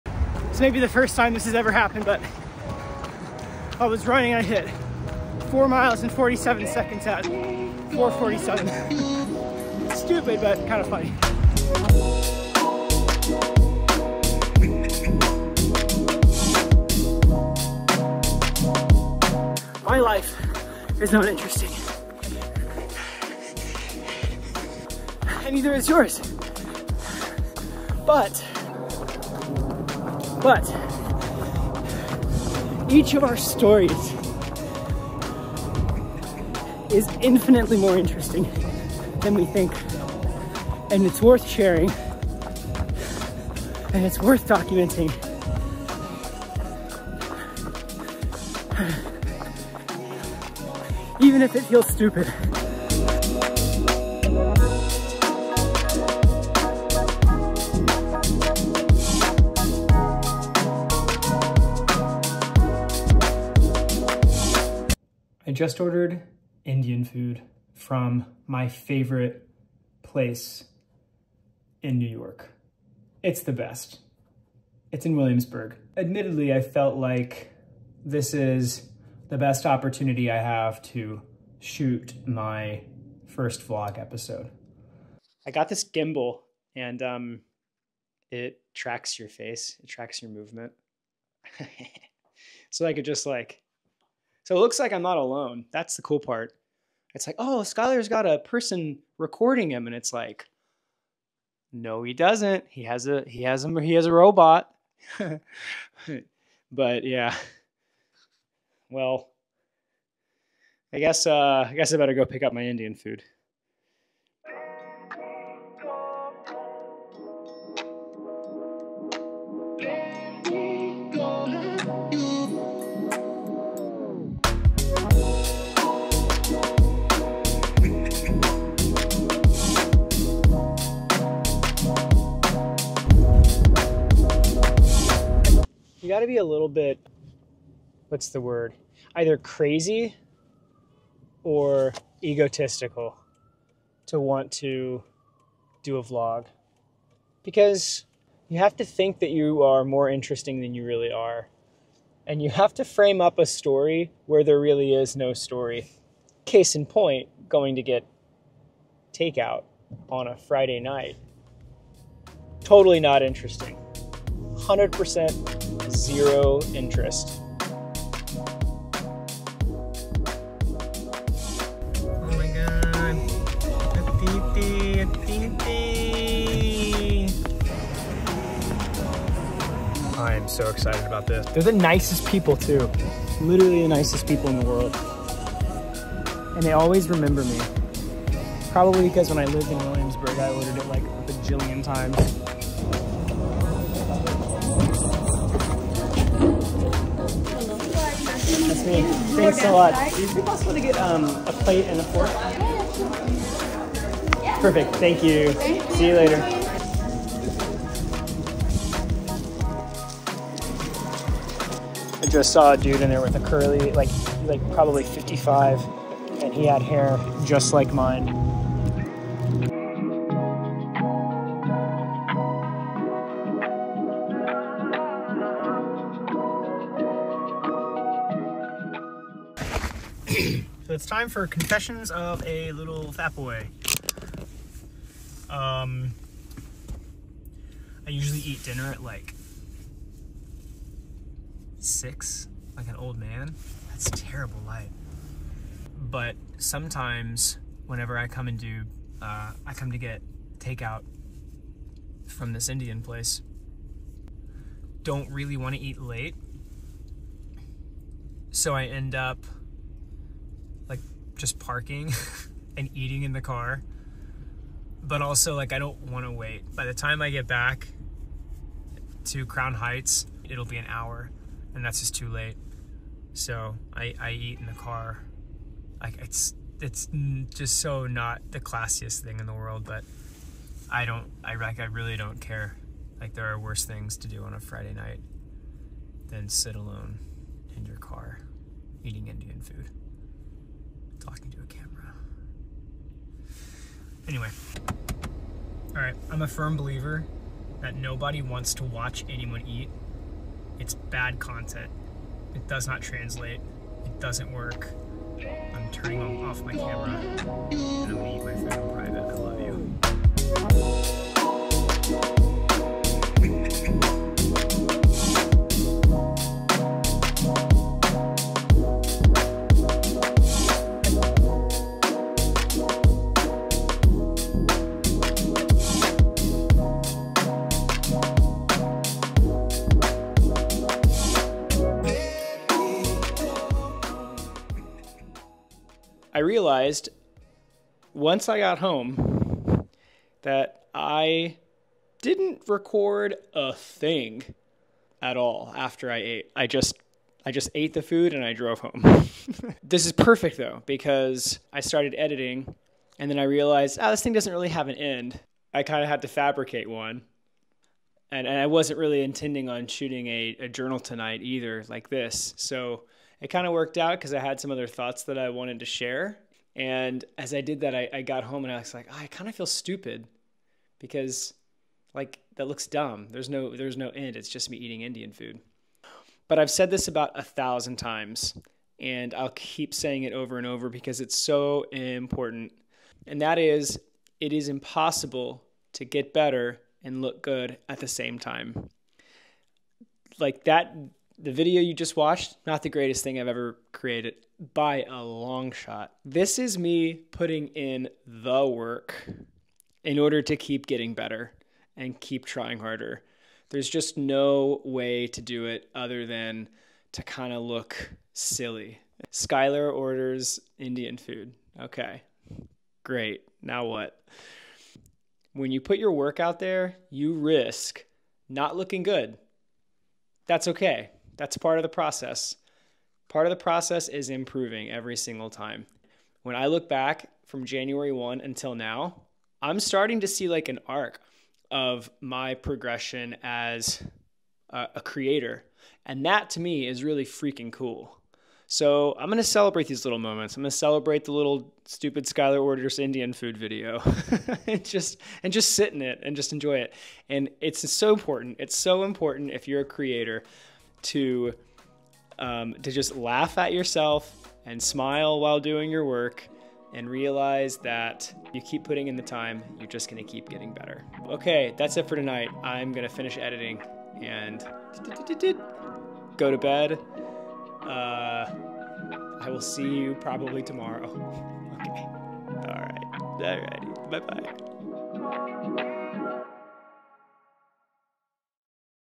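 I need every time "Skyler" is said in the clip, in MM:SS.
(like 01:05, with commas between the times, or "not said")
01:37, 06:49, 07:22.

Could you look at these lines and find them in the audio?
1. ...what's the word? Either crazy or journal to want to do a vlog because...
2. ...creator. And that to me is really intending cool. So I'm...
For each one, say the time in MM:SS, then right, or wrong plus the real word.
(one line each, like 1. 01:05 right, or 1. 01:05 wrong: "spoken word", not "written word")
1. 02:18 wrong: "egotistical", not "journal"
2. 07:15 wrong: "freaking", not "intending".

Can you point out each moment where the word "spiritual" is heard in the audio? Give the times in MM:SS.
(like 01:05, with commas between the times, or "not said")
not said.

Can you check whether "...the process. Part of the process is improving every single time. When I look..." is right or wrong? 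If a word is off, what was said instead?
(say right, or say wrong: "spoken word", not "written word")
right.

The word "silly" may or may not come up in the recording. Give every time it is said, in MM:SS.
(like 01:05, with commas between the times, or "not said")
06:48.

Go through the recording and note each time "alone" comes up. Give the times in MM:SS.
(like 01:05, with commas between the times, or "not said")
01:35, 04:46.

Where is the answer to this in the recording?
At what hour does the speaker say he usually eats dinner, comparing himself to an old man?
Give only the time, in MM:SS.
04:01.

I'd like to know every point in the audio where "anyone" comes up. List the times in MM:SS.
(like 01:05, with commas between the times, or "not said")
04:59.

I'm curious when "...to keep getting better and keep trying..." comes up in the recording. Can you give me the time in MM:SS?
06:40.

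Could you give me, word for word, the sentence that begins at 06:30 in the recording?
Like that the video you just watched, not the greatest thing I've ever created by a long shot.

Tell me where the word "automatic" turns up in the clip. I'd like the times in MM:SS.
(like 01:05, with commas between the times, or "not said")
not said.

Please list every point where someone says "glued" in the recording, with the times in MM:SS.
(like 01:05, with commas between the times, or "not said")
not said.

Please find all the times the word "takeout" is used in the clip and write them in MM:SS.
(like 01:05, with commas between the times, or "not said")
02:39, 04:10.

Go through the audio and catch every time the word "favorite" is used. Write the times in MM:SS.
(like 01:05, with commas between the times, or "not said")
01:08.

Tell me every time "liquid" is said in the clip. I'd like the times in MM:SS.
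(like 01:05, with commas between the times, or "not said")
not said.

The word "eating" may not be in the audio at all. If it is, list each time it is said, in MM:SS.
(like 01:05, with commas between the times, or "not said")
04:22, 04:49, 06:14.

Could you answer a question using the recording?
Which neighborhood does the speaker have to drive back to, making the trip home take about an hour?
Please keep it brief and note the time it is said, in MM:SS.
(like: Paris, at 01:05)
Crown Heights, at 04:29.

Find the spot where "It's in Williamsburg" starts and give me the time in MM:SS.
01:14.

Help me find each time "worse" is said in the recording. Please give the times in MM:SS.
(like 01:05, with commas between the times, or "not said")
04:43.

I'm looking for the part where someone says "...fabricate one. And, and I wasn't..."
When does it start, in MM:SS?
05:56.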